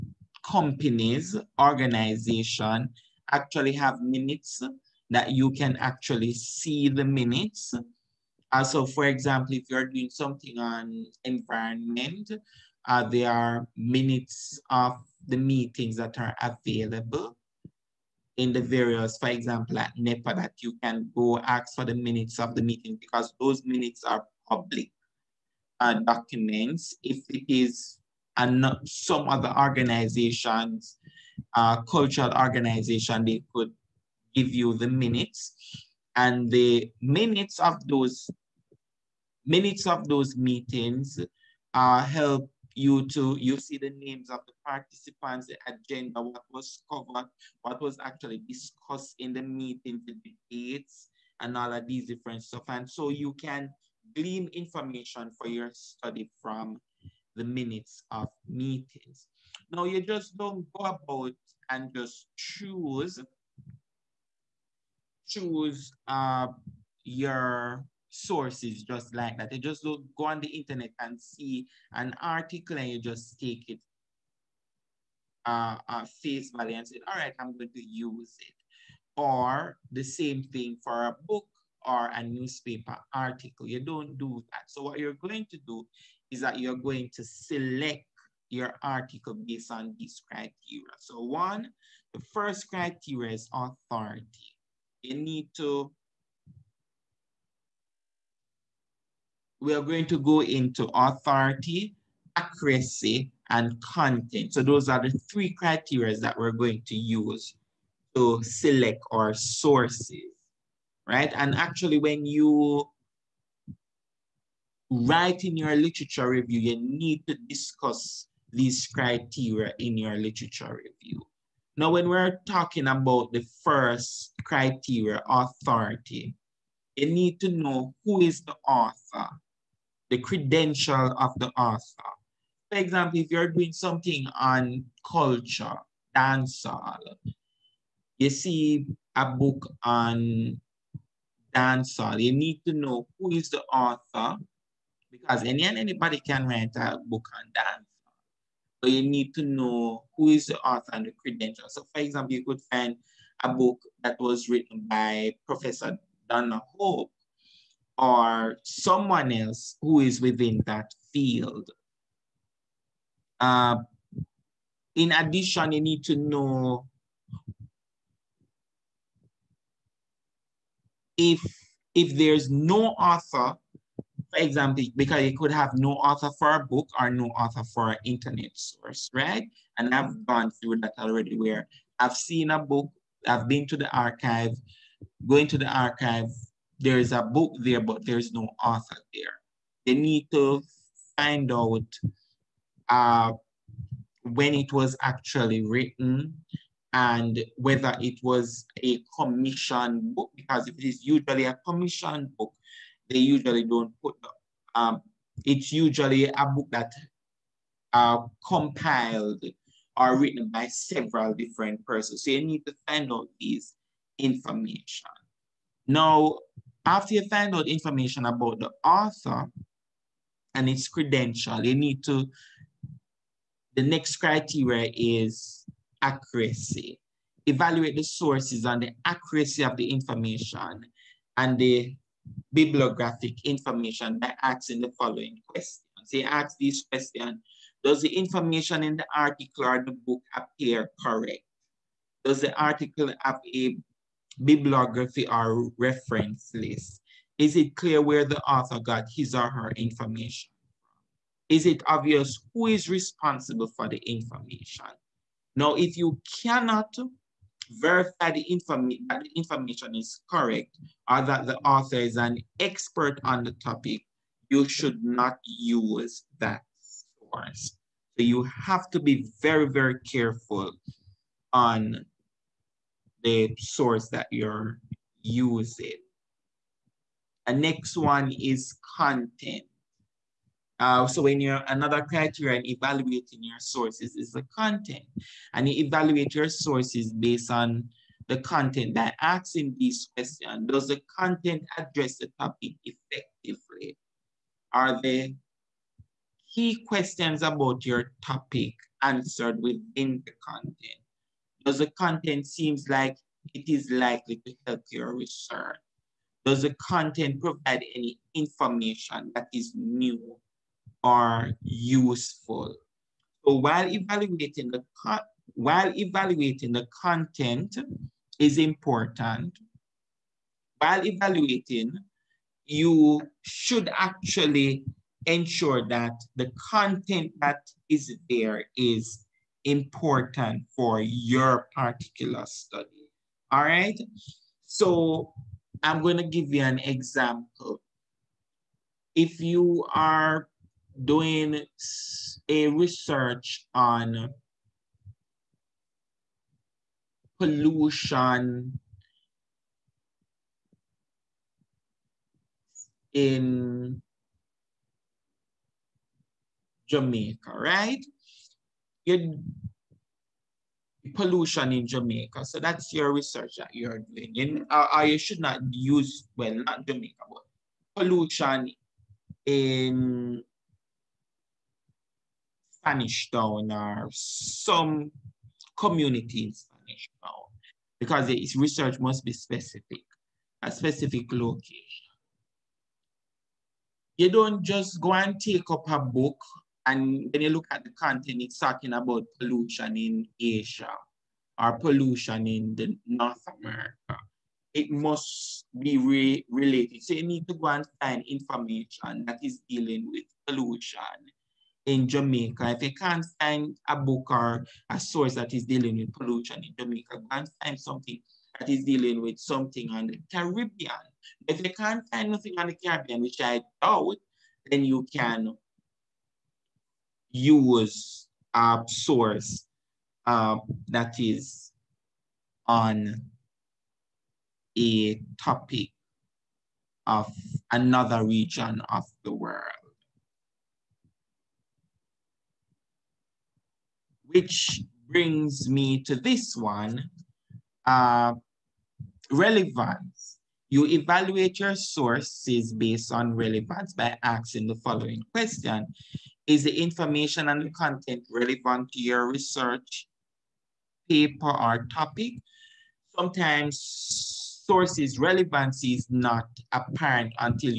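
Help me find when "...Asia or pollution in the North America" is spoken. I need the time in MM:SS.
06:30.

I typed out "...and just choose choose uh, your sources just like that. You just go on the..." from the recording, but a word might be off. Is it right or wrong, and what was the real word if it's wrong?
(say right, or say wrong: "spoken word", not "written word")
right.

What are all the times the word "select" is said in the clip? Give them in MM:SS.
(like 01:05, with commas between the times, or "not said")
01:27, 01:48.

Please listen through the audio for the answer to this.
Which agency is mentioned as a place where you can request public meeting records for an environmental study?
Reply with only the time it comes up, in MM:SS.
00:19.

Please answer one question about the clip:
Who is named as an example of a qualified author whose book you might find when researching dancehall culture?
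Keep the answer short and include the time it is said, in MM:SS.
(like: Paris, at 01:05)
Professor Donna Hope, at 02:35.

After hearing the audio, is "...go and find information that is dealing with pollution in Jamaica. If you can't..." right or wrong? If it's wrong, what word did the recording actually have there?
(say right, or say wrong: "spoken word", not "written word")
right.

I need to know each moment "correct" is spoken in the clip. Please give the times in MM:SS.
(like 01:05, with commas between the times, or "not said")
04:01, 04:20.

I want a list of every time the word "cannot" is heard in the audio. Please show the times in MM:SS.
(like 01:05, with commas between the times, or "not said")
04:16.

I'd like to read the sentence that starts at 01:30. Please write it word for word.
So one, the first criteria is authority you need to, we are going to go into authority, accuracy, and content.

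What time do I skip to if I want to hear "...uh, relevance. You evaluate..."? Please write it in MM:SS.
07:17.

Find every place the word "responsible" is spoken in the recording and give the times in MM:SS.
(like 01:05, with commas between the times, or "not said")
04:12.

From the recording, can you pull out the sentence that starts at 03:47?
Evaluate the sources and the accuracy of the information and the bibliographic information by asking the following questions.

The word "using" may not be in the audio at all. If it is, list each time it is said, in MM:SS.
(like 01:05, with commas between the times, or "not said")
04:35.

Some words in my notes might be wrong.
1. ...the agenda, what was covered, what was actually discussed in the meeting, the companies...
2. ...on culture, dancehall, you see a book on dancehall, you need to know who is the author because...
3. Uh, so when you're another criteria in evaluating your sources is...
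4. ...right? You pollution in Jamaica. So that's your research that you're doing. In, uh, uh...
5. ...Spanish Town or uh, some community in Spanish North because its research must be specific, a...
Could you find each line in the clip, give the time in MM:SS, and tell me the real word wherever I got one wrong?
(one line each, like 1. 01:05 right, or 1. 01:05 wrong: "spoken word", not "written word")
1. 00:45 wrong: "debates", not "companies"
2. 02:14 right
3. 04:40 right
4. 05:57 right
5. 06:12 wrong: "Town", not "North".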